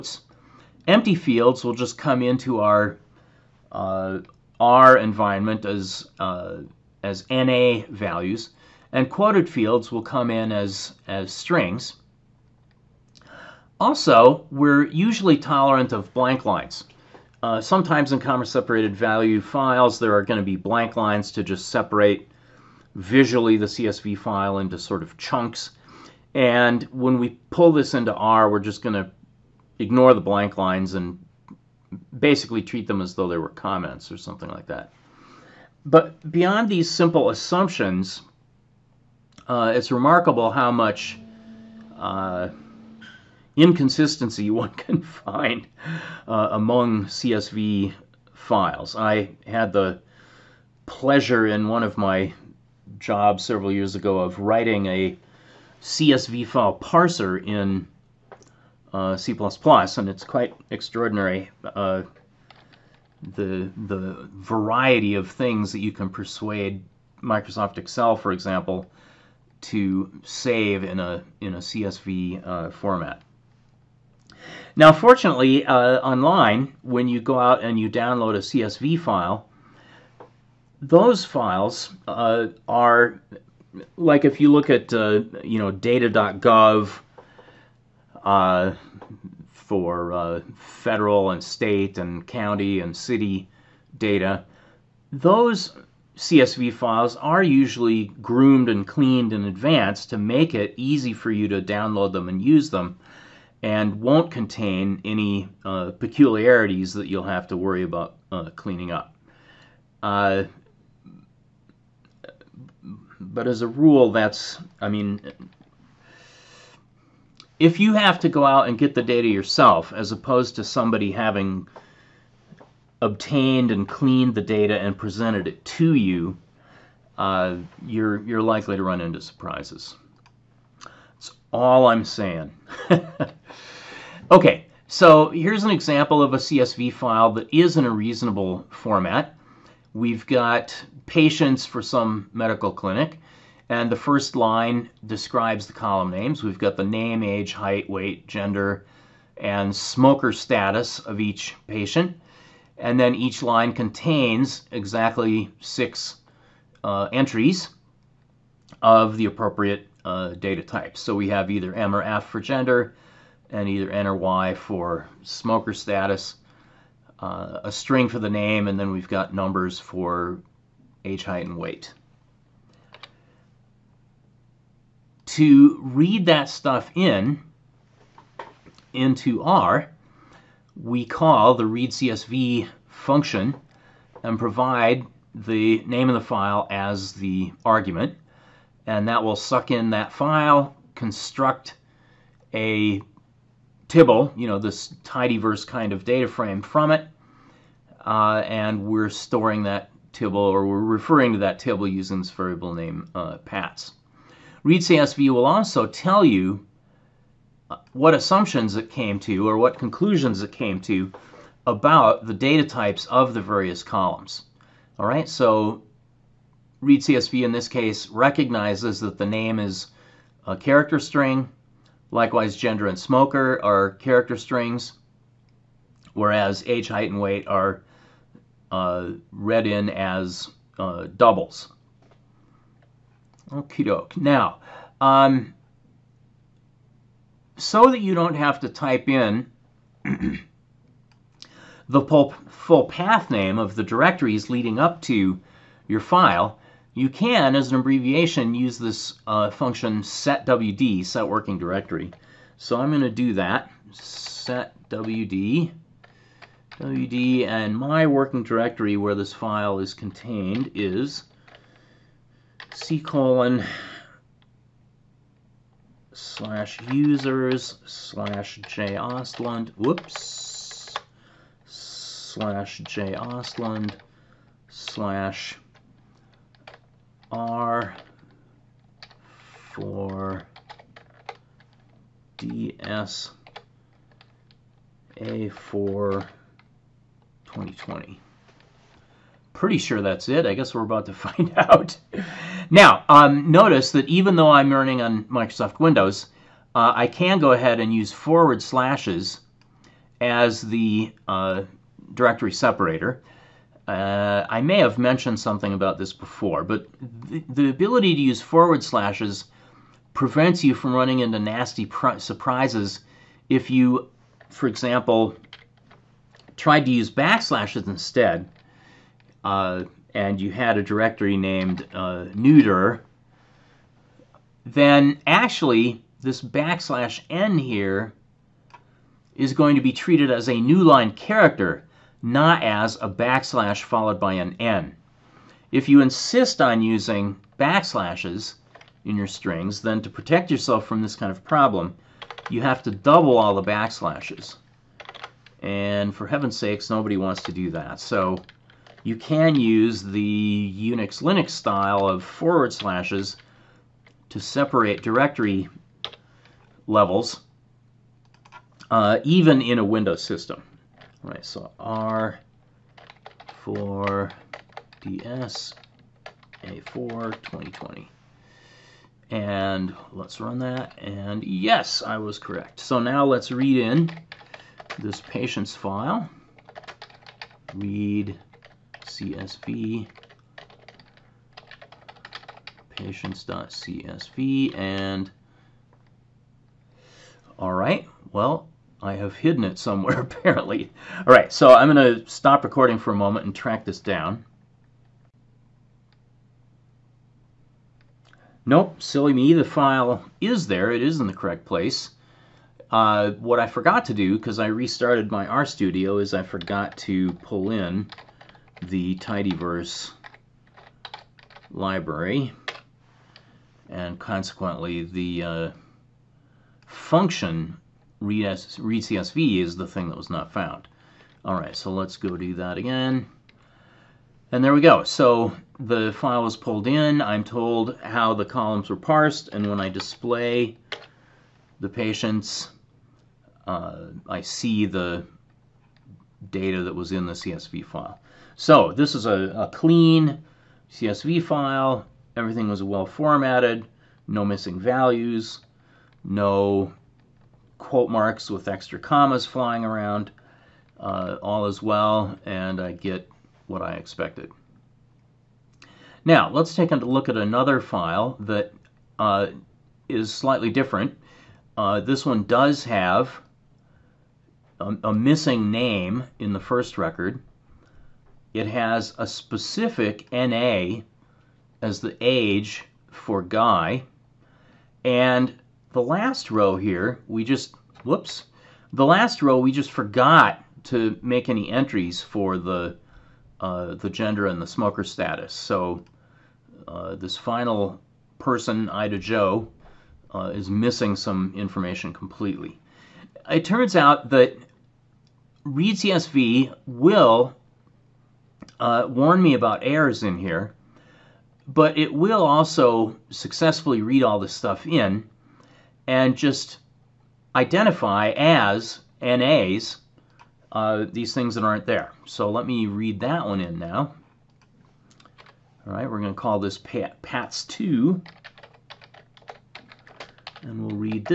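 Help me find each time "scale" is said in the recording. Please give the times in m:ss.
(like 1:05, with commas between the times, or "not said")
not said.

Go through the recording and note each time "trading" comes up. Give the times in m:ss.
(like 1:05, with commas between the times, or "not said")
not said.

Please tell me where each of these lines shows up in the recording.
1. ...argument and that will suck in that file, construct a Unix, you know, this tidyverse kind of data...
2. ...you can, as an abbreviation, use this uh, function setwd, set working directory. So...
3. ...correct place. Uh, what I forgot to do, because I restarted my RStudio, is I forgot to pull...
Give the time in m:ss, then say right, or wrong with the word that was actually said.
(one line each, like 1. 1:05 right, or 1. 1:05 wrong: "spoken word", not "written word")
1. 3:07 wrong: "Tibble", not "Unix"
2. 4:06 right
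3. 6:41 right.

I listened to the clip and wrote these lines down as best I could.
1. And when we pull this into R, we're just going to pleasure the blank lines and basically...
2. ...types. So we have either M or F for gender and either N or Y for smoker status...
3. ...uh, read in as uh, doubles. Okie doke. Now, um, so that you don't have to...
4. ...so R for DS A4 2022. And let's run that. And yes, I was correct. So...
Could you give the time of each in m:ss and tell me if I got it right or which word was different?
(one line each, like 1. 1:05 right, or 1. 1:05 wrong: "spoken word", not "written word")
1. 0:26 wrong: "ignore", not "pleasure"
2. 2:40 right
3. 3:48 right
4. 6:01 wrong: "2020", not "2022".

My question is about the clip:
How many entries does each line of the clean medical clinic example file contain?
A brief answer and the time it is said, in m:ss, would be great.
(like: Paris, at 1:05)
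6, at 2:35.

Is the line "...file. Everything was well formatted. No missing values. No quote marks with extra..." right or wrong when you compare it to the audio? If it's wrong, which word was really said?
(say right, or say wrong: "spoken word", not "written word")
right.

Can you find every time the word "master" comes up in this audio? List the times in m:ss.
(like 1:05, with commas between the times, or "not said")
not said.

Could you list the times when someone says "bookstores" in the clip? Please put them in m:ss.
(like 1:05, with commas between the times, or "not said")
not said.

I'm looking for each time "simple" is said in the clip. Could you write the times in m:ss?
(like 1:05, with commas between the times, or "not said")
0:36.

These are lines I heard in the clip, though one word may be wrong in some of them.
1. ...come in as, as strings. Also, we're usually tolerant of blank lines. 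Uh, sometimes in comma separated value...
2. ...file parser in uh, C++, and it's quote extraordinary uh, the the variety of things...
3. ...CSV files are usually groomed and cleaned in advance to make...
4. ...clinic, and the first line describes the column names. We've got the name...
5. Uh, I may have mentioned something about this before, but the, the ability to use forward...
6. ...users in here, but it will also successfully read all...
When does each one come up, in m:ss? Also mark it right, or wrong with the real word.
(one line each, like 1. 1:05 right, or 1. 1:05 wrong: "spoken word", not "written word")
1. 0:10 right
2. 0:56 wrong: "quite", not "quote"
3. 1:36 right
4. 2:22 right
5. 5:03 right
6. 8:19 wrong: "errors", not "users".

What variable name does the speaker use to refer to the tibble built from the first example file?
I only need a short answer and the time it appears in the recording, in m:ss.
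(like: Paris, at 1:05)
pats, at 3:23.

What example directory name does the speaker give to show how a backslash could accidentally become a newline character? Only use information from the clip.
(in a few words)
neuter.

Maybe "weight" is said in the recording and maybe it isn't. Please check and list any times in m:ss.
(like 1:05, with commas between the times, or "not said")
2:27, 2:51, 3:47.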